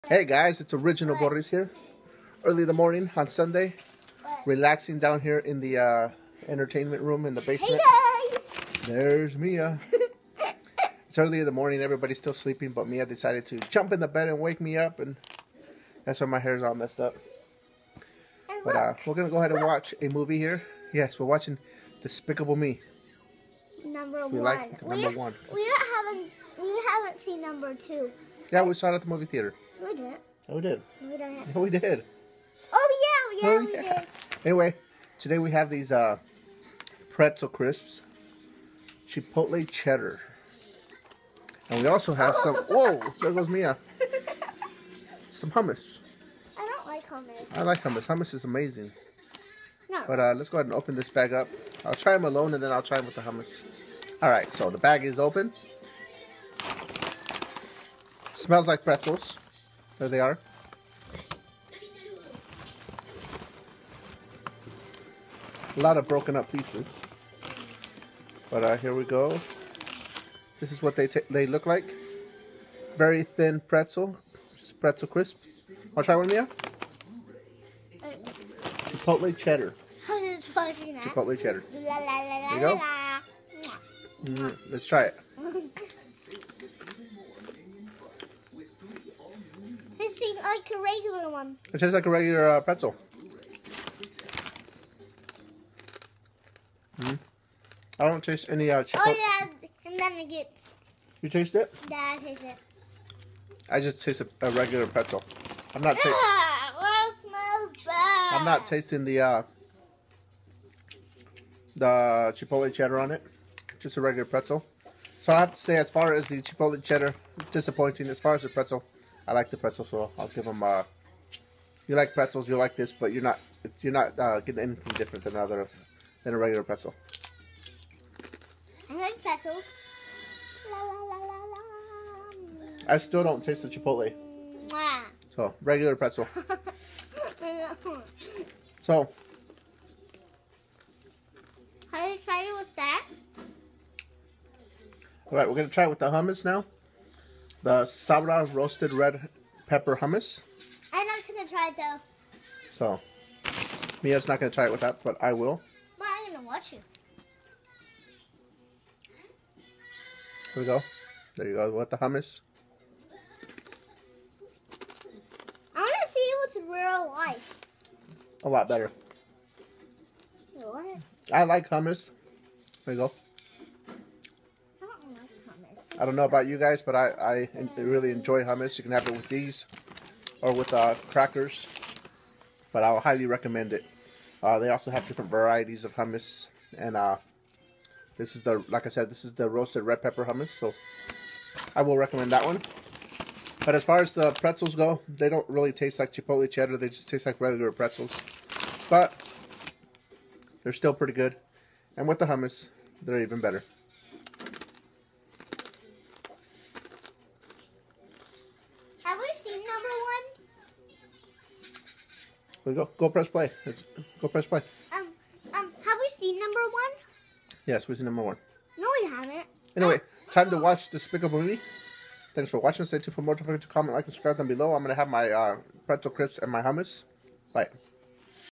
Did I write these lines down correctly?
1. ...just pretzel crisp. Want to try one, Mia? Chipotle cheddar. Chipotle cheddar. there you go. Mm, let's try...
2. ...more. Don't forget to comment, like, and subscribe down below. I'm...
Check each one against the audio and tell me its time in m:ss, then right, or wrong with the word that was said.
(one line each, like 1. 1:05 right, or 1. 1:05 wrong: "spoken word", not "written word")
1. 1:14 right
2. 3:43 right.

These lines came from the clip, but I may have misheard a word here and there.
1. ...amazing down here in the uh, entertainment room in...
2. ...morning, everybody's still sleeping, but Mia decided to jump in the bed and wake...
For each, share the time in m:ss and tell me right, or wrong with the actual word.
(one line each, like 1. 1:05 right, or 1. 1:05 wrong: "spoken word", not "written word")
1. 0:04 wrong: "relaxing", not "amazing"
2. 0:11 right.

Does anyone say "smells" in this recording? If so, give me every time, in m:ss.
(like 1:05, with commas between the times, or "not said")
0:58, 1:47.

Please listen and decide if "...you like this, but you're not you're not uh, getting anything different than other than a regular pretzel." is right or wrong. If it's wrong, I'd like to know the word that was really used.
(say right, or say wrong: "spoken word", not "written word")
right.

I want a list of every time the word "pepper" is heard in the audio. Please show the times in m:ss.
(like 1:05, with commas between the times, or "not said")
2:29, 3:10.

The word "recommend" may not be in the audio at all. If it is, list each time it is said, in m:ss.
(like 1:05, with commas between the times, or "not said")
3:03, 3:11.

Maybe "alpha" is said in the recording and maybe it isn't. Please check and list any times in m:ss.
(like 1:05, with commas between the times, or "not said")
not said.